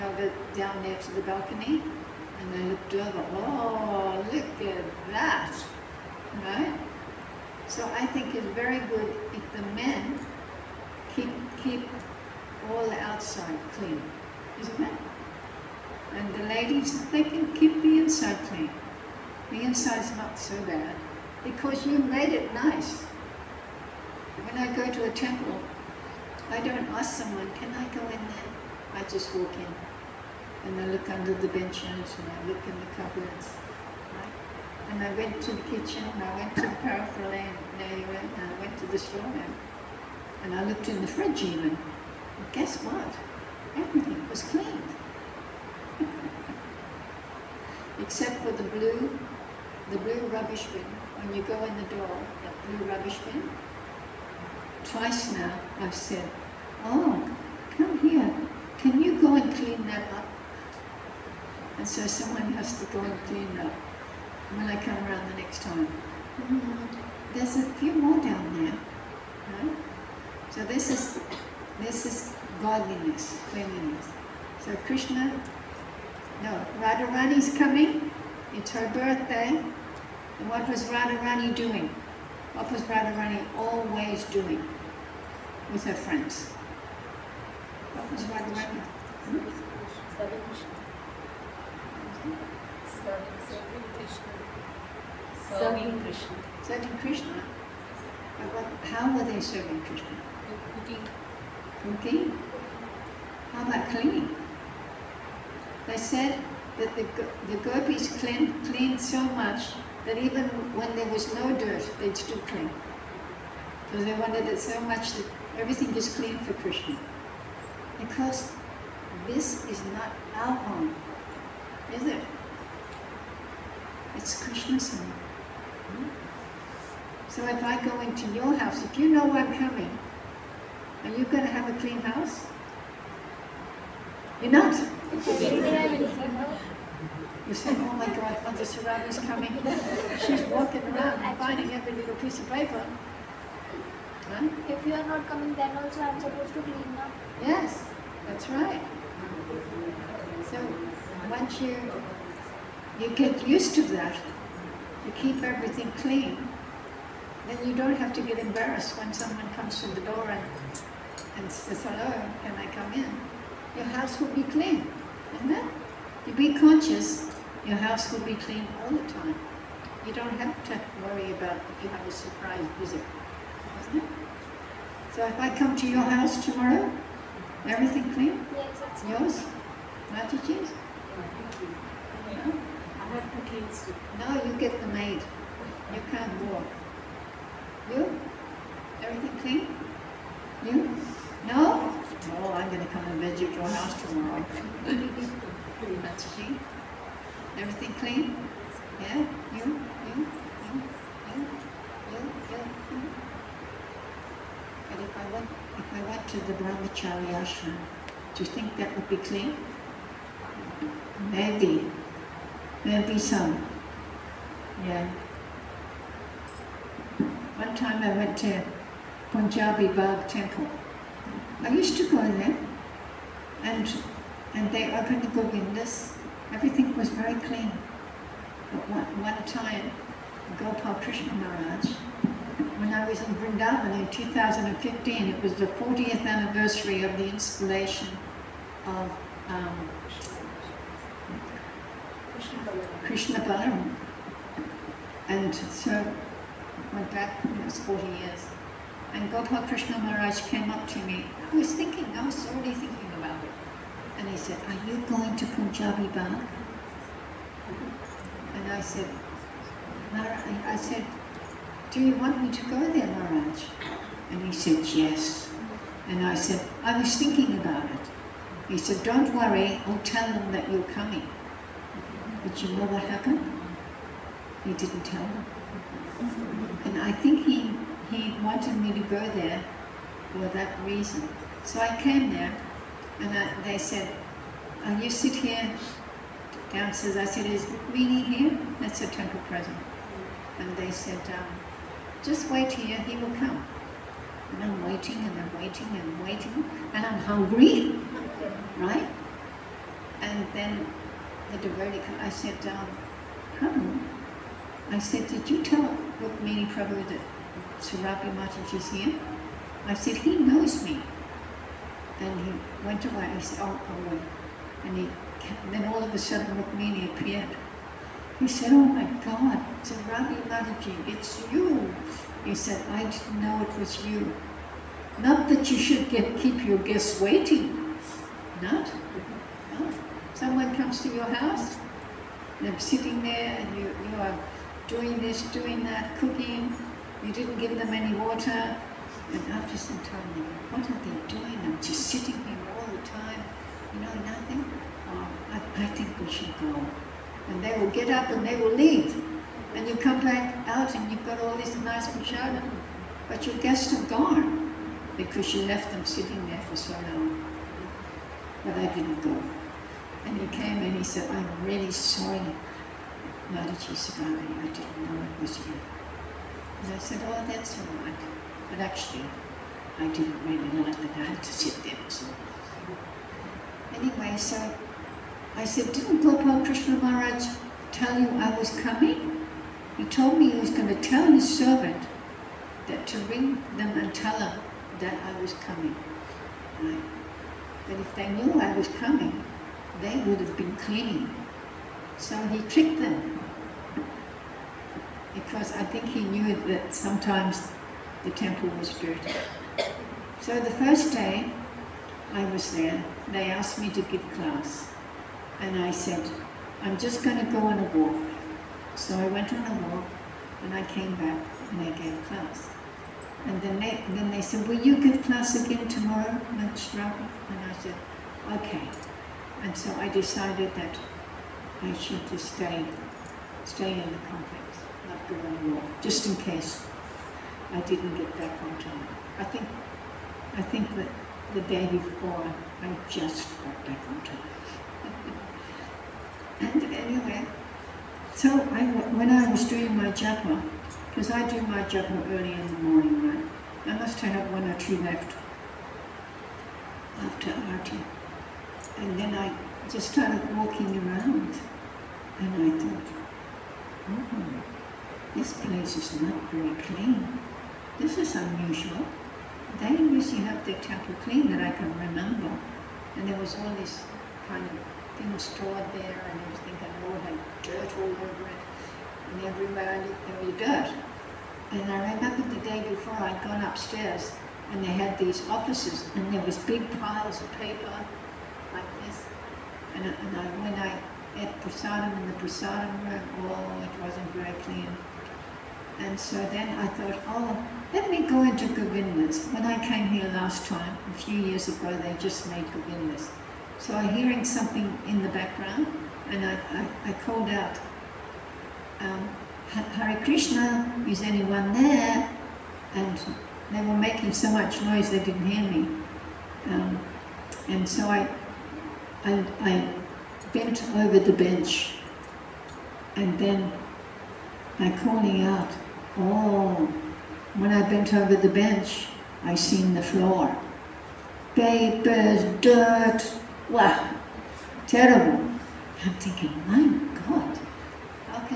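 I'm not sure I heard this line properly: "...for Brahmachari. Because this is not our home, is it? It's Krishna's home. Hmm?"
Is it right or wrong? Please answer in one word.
wrong.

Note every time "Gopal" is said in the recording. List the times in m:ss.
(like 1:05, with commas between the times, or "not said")
3:50, 4:09, 6:16.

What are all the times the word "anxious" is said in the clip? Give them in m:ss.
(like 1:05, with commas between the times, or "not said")
not said.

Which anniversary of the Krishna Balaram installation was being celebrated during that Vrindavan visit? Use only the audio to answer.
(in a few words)
40th.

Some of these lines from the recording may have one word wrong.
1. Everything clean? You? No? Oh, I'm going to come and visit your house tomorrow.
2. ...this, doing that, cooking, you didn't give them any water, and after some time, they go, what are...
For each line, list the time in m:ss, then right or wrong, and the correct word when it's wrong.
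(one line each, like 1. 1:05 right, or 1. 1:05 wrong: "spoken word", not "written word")
1. 3:09 right
2. 5:35 right.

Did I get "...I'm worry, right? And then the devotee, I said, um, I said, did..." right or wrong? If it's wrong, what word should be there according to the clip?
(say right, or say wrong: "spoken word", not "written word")
wrong: "hungry", not "worry".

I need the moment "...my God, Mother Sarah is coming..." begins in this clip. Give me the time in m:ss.
2:17.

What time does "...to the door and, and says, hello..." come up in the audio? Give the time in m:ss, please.
2:39.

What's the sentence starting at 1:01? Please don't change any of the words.
And so someone has to go and clean that.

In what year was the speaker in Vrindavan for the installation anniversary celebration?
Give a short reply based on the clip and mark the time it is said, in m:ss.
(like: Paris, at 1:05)
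2015, at 3:54.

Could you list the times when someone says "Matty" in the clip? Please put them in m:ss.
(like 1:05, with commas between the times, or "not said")
3:00, 3:14.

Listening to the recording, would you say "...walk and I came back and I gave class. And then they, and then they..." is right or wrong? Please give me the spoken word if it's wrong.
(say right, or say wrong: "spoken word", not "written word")
right.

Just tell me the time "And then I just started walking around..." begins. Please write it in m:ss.
7:28.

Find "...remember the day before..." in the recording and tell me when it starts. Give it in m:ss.
7:52.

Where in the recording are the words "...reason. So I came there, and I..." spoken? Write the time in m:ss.
4:40.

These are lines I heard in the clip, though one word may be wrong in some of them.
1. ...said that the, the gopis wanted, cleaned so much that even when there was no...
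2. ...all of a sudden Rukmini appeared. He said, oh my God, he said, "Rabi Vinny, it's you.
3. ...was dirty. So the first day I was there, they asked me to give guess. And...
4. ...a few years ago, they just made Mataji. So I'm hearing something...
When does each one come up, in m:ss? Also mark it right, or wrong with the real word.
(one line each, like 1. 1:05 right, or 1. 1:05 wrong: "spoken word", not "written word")
1. 1:45 wrong: "cleaned", not "wanted"
2. 5:15 wrong: "Mataji", not "Vinny"
3. 6:38 wrong: "class", not "guess"
4. 8:11 wrong: "Govindas", not "Mataji".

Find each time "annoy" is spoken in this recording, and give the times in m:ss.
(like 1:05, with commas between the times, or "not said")
not said.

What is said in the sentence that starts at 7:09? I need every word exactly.
I think, I think that the day before I just got back on time.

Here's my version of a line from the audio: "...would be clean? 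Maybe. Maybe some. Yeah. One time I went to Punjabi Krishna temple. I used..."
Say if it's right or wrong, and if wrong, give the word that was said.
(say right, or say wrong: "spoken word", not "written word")
wrong: "Bagh", not "Krishna".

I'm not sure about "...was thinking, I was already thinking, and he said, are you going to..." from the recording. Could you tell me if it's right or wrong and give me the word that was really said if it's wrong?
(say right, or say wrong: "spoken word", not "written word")
right.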